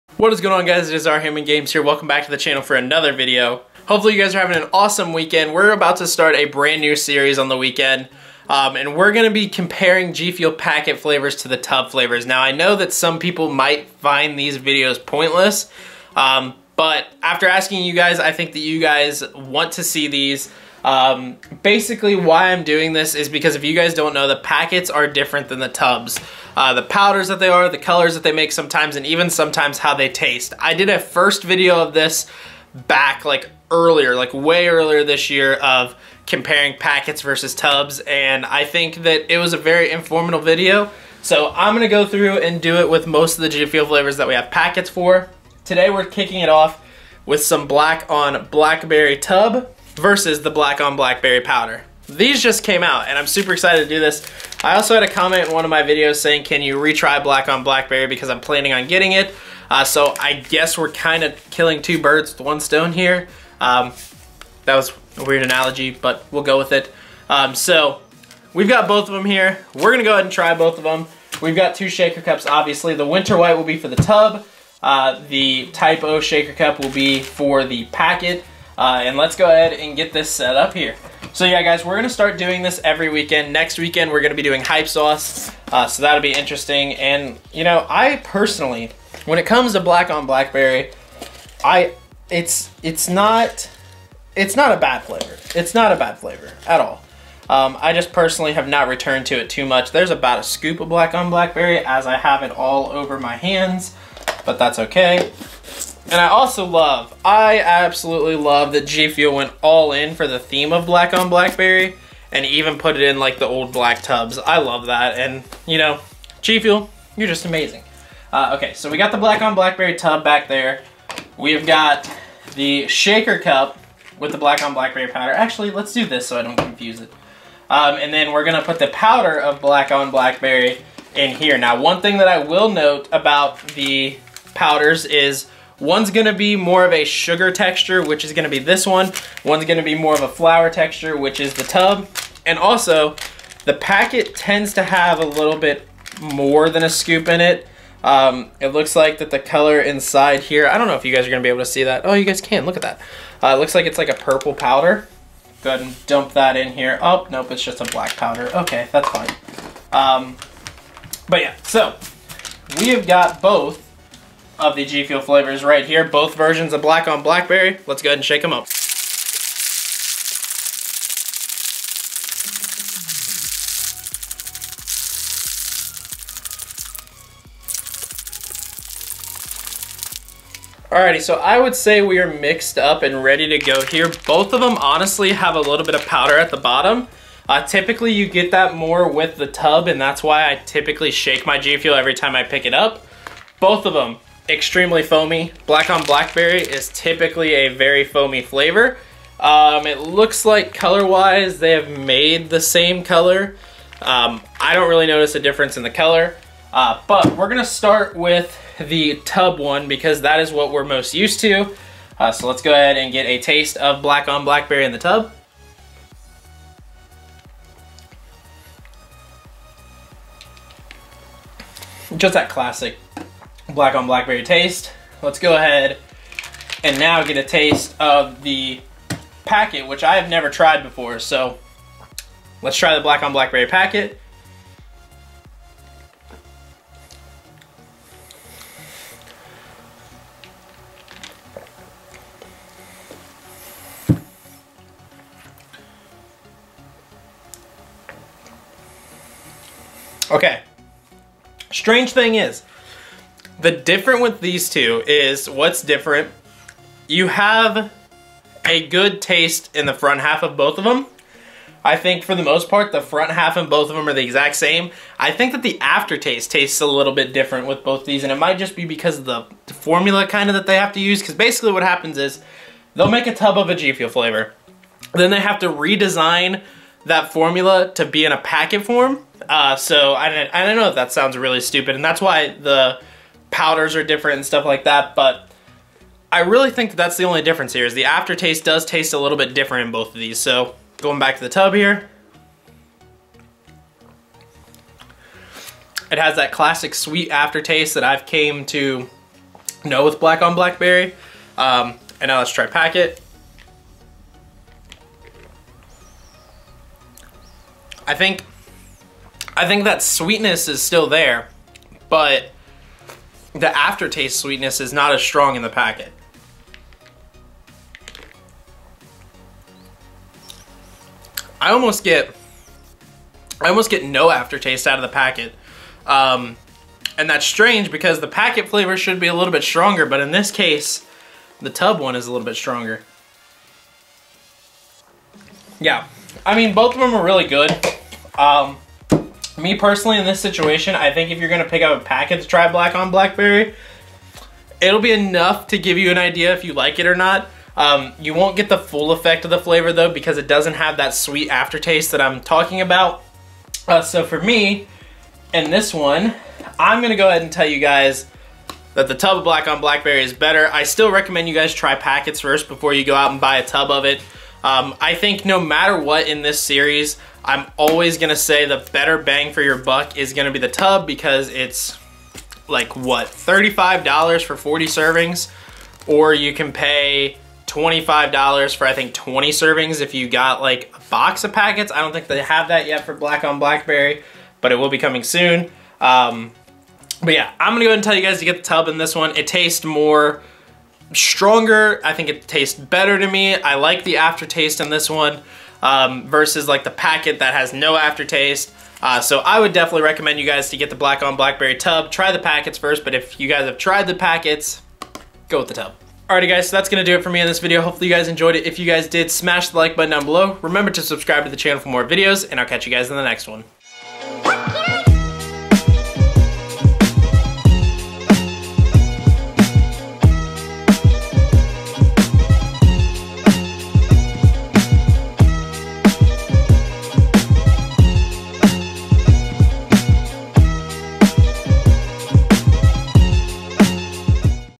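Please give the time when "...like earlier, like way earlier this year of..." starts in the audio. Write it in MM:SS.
00:33.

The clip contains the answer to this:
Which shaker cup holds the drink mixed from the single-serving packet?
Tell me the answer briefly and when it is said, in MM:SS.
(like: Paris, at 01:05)
Type O, at 01:15.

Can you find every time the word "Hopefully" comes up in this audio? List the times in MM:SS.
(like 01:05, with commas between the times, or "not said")
00:03, 06:47.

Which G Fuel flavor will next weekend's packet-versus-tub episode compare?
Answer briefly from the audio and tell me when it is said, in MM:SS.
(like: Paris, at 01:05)
Hype Sauce, at 01:24.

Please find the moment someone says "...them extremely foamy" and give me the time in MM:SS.
03:13.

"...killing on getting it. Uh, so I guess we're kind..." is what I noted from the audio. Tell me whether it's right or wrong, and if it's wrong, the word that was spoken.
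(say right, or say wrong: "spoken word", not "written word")
wrong: "planning", not "killing".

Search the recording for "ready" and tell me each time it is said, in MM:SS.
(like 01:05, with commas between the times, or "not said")
03:03.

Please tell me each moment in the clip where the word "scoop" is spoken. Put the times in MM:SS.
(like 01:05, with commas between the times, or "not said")
01:40, 02:26.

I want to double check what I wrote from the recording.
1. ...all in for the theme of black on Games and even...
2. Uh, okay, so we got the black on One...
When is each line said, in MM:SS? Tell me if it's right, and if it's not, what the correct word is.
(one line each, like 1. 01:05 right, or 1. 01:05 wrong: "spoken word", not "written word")
1. 01:49 wrong: "Blackberry", not "Games"
2. 01:58 wrong: "Blackberry", not "One".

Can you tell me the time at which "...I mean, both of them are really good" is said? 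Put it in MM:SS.
05:36.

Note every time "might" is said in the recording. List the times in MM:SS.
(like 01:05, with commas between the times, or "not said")
00:13, 04:28.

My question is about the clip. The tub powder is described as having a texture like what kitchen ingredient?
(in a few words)
flour.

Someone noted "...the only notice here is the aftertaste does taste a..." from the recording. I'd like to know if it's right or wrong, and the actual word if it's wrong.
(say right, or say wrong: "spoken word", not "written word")
wrong: "difference", not "notice".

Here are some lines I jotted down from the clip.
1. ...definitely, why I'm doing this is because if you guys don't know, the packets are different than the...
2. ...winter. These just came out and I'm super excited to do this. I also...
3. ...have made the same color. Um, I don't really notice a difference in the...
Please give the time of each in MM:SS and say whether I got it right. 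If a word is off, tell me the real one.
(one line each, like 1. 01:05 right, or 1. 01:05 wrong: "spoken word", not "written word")
1. 00:21 wrong: "basically", not "definitely"
2. 00:51 wrong: "powder", not "winter"
3. 03:21 right.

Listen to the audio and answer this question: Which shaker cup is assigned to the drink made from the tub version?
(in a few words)
Winter White.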